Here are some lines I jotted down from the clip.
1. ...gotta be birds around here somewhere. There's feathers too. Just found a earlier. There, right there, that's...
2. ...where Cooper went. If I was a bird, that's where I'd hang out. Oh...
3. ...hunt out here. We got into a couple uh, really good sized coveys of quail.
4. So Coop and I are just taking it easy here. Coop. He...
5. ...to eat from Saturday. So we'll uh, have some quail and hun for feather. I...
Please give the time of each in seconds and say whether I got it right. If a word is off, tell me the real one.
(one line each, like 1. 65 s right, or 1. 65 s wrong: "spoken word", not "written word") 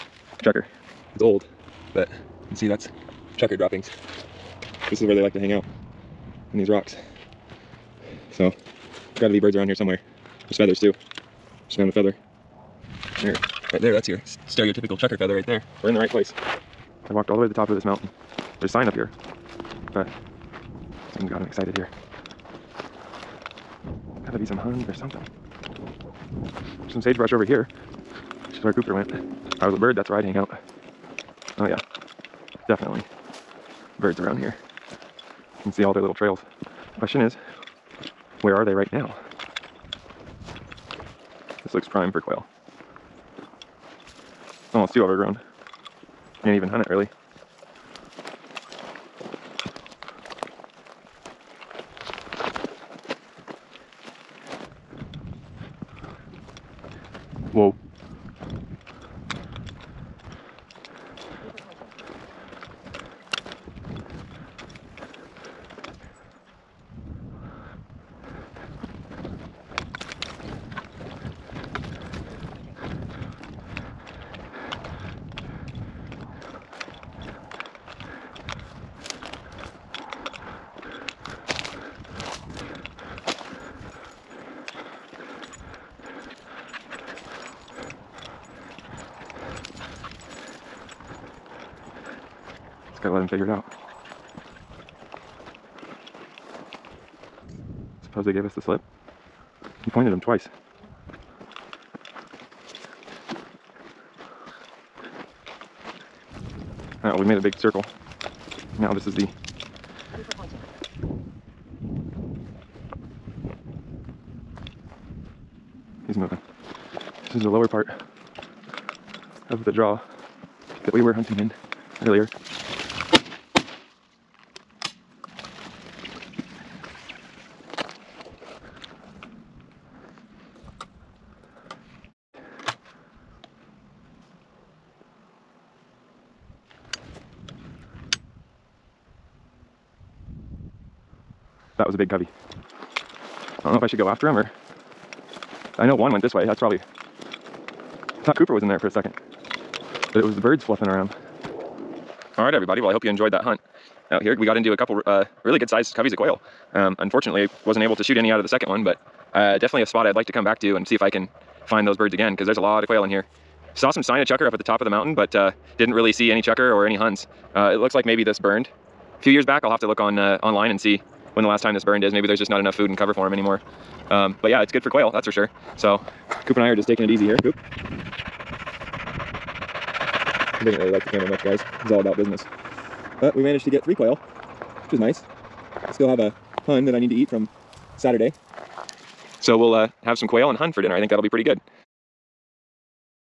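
1. 9 s wrong: "feather", not "earlier"
2. 28 s right
3. 153 s right
4. 175 s right
5. 187 s wrong: "dinner", not "feather".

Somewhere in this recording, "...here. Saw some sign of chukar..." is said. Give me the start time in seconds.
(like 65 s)
163 s.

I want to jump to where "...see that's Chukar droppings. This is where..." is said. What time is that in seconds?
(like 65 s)
2 s.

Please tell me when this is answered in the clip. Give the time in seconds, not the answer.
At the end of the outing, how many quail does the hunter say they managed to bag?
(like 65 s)
183 s.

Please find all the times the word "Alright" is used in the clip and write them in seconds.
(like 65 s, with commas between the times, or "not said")
107 s.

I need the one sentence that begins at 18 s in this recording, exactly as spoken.
There's a sign up here, but something's got him excited here.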